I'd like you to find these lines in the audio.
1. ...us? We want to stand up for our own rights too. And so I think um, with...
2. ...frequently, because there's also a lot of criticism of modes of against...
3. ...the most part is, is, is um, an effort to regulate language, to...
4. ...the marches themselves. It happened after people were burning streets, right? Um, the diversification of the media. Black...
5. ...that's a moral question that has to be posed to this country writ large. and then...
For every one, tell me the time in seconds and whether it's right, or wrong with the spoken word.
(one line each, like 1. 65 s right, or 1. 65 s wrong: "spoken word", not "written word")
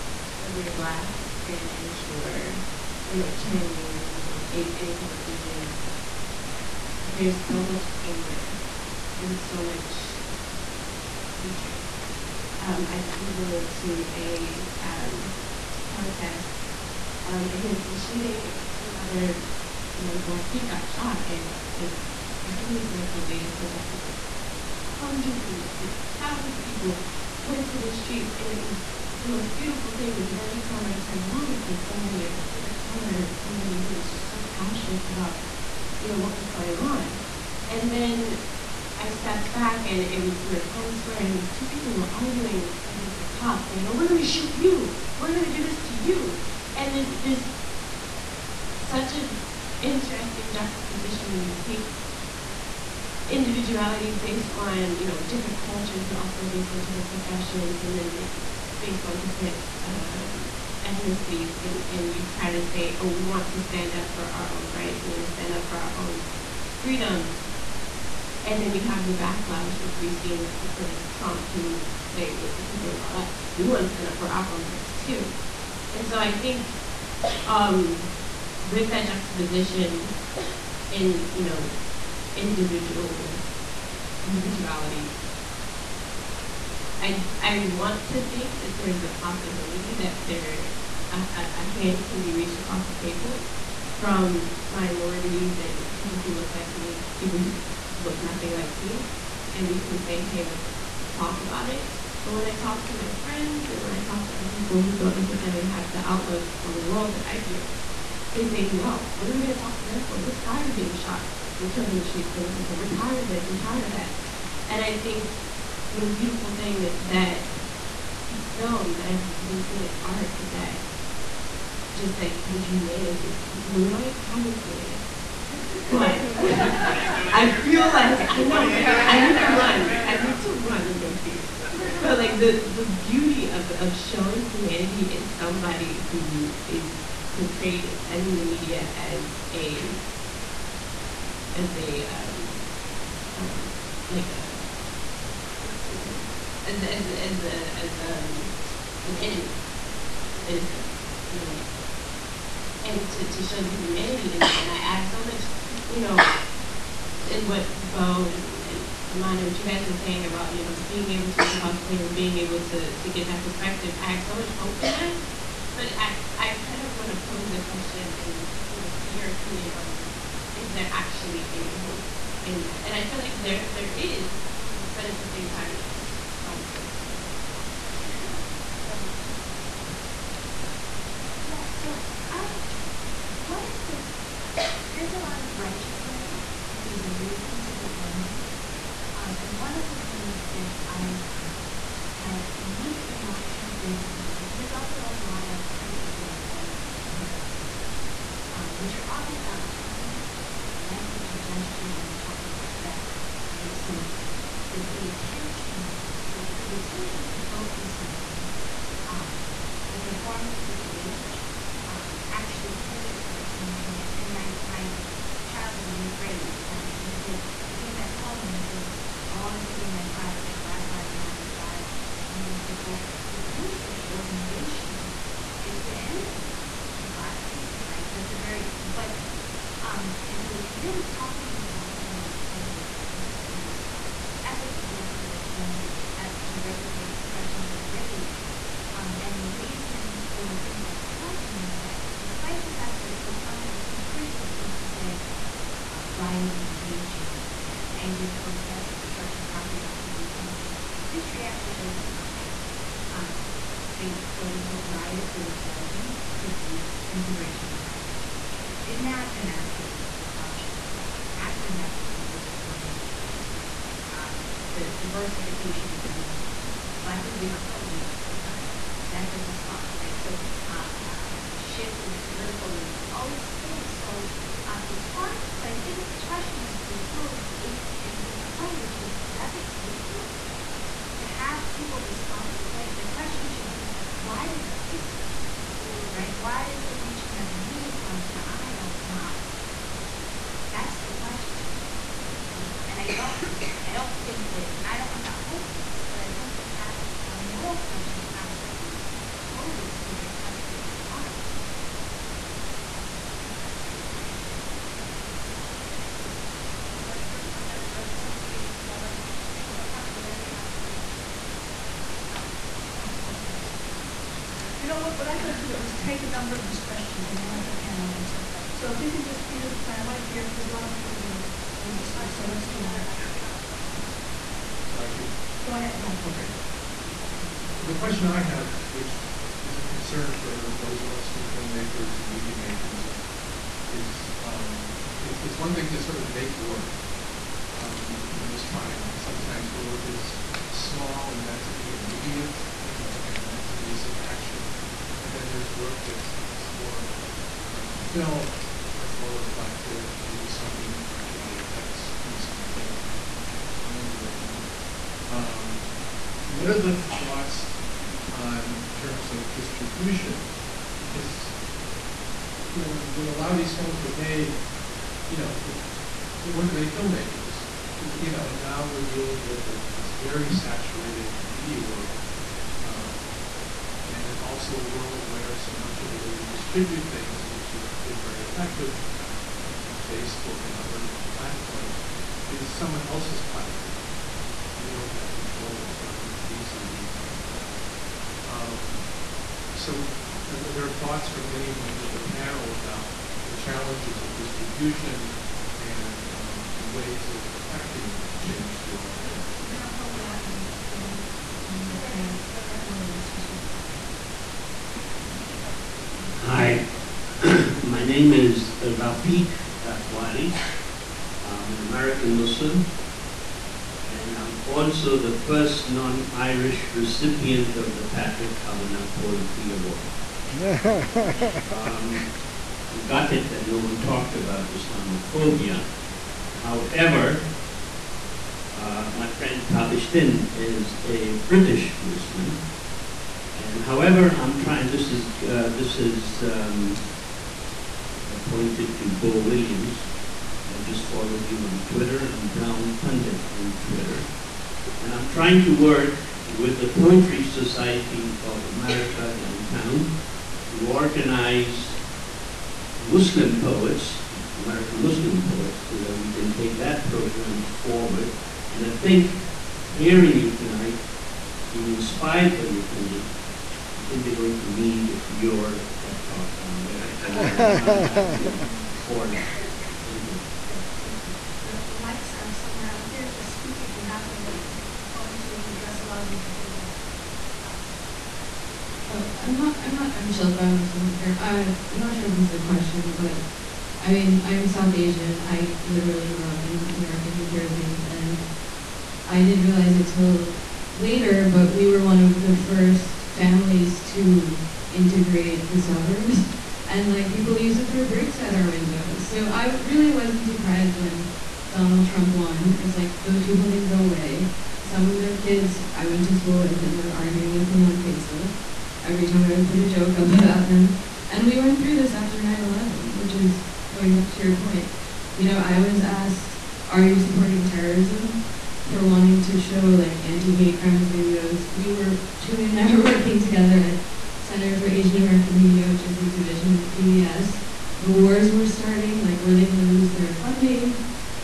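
1. 73 s right
2. 193 s wrong: "protest", not "against"
3. 232 s right
4. 260 s right
5. 296 s right.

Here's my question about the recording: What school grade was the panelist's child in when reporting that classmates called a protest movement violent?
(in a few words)
8th grade.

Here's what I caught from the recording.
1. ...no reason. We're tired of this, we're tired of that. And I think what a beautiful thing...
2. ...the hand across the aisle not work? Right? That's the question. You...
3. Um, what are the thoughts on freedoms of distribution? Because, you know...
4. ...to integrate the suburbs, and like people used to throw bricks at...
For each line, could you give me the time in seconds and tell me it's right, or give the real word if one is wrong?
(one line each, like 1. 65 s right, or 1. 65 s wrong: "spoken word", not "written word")
1. 112 s right
2. 287 s right
3. 355 s wrong: "terms", not "freedoms"
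4. 494 s right.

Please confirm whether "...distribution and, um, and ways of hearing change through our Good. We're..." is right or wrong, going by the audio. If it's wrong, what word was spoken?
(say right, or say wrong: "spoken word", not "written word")
wrong: "affecting", not "hearing".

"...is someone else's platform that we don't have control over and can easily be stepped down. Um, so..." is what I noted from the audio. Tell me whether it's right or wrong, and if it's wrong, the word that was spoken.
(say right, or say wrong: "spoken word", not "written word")
wrong: "clamped", not "stepped".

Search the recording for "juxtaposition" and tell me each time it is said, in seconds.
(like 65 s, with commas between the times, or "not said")
50 s, 79 s.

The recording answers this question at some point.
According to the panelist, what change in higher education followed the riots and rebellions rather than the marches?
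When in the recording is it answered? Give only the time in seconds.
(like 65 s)
257 s.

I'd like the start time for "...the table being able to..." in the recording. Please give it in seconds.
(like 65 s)
161 s.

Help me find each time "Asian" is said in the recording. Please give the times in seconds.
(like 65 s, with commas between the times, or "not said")
5 s, 484 s, 524 s.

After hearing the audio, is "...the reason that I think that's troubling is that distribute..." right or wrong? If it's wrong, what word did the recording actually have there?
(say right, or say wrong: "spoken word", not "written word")
wrong: "despite", not "distribute".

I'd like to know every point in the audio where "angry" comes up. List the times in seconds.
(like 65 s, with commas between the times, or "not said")
187 s, 248 s.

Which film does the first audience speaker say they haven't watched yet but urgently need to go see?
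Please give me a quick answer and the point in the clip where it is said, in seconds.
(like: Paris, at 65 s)
Moonlight, at 123 s.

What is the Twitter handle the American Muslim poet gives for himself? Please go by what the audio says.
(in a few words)
Brown Pundit.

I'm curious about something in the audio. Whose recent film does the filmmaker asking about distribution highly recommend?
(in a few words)
Raoul Peck.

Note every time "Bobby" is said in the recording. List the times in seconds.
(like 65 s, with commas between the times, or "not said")
not said.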